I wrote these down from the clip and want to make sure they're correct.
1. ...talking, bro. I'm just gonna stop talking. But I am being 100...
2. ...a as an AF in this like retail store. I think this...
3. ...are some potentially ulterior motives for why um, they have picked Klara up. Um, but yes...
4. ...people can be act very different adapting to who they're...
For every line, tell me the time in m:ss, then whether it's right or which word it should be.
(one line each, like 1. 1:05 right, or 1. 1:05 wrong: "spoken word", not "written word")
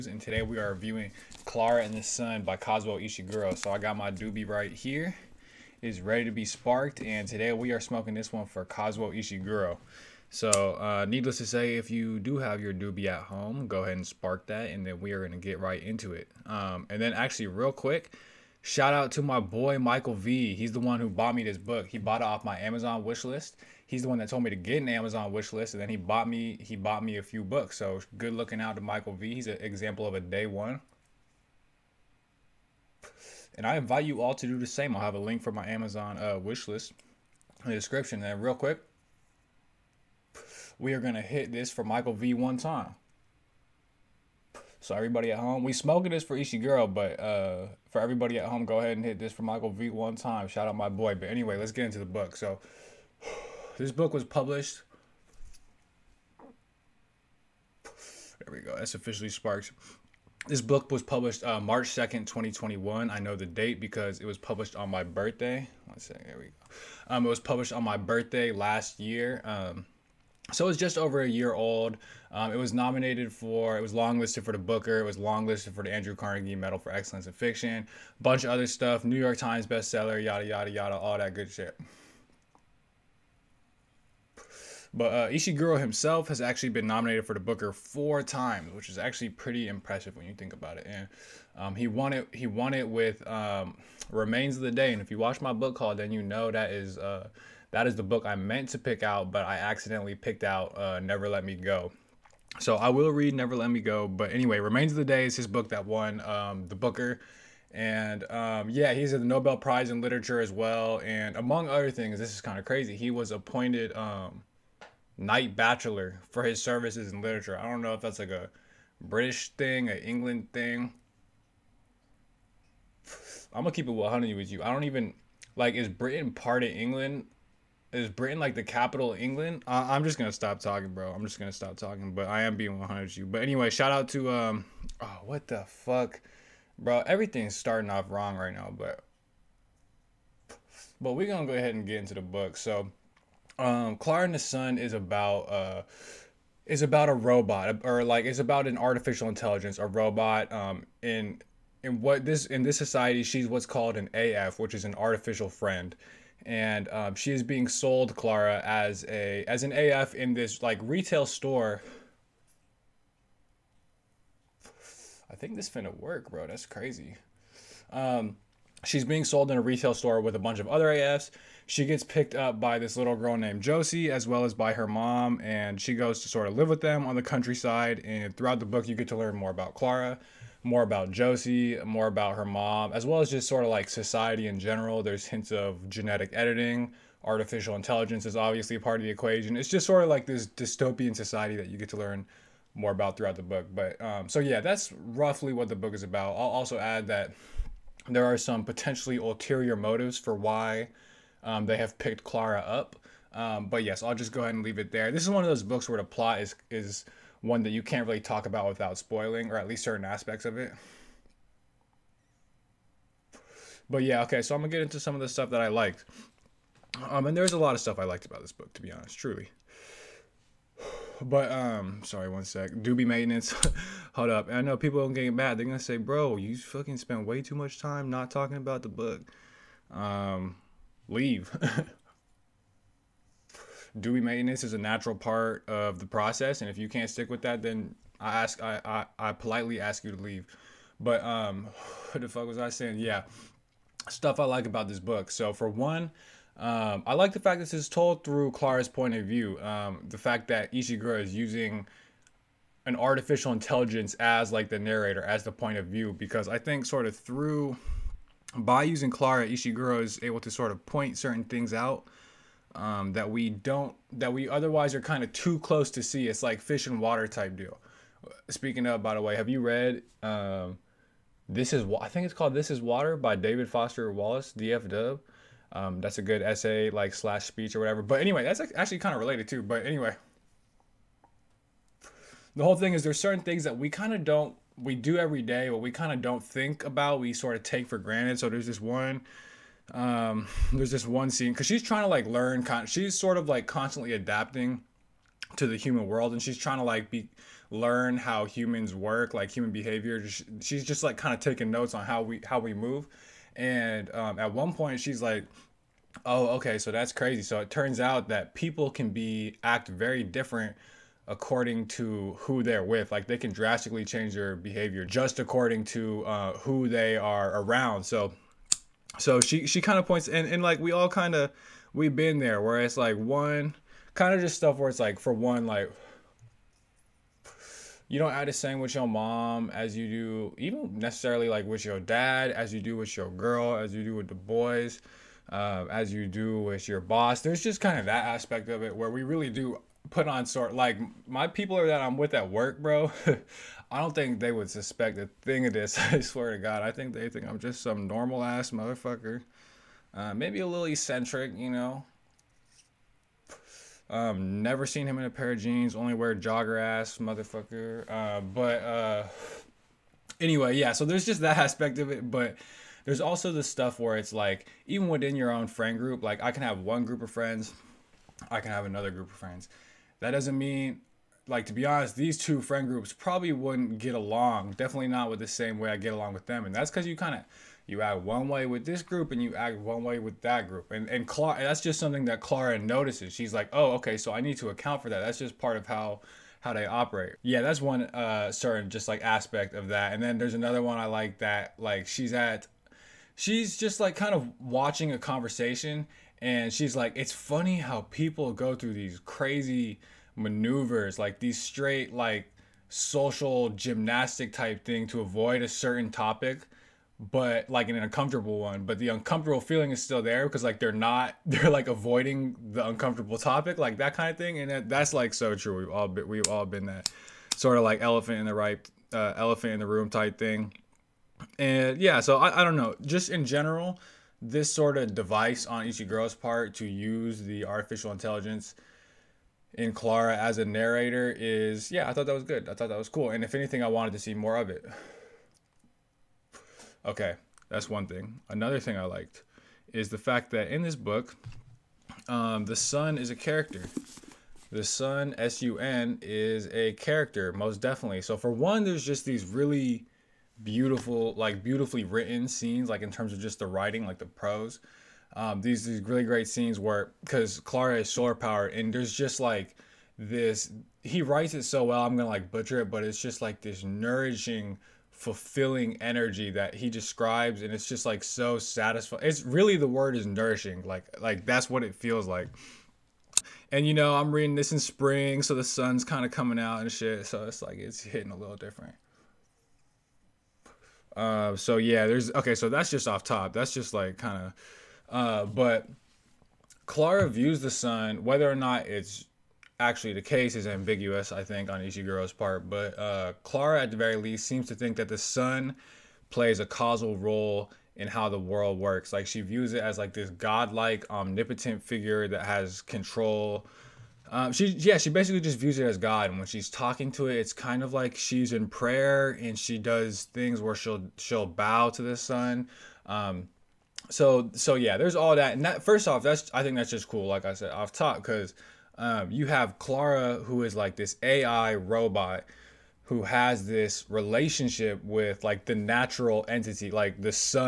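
1. 2:10 right
2. 2:39 right
3. 3:18 right
4. 5:08 wrong: "according", not "adapting".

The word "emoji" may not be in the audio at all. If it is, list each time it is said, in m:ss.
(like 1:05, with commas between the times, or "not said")
not said.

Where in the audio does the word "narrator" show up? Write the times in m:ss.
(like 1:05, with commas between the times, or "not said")
4:14, 7:10.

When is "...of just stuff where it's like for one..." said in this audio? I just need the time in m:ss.
5:24.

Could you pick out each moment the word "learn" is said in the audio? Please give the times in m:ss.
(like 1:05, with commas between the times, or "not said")
2:59, 3:11, 4:52, 4:57.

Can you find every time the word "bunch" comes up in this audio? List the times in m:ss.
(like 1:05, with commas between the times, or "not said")
1:18, 2:50.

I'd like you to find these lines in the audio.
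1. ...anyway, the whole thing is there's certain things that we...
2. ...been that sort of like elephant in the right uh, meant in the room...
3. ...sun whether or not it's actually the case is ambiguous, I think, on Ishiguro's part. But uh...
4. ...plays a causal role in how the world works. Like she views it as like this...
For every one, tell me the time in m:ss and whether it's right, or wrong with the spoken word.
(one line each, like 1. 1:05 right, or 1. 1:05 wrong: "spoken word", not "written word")
1. 4:39 right
2. 6:56 wrong: "elephant", not "meant"
3. 8:07 right
4. 8:16 right.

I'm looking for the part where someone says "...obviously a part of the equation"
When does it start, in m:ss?
3:08.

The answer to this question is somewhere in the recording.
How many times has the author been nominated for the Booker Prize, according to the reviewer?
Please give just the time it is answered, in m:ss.
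1:27.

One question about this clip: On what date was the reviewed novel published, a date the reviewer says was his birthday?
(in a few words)
March 2nd, 2021.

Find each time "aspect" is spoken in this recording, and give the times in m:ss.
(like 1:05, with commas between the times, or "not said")
3:30, 5:38, 6:01, 6:29.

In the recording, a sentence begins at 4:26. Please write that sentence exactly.
It's like fish and water type deal.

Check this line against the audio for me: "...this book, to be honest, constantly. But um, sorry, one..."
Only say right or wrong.
wrong.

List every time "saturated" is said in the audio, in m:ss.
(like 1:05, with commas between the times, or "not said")
not said.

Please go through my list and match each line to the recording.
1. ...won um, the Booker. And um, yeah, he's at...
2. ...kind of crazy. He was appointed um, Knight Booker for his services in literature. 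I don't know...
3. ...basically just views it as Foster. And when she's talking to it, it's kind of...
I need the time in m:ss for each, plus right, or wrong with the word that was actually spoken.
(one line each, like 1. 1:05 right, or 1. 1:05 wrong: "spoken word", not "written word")
1. 1:45 right
2. 1:52 wrong: "Bachelor", not "Booker"
3. 8:25 wrong: "God", not "Foster".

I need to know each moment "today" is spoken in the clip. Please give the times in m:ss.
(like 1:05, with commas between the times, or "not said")
0:00, 0:07.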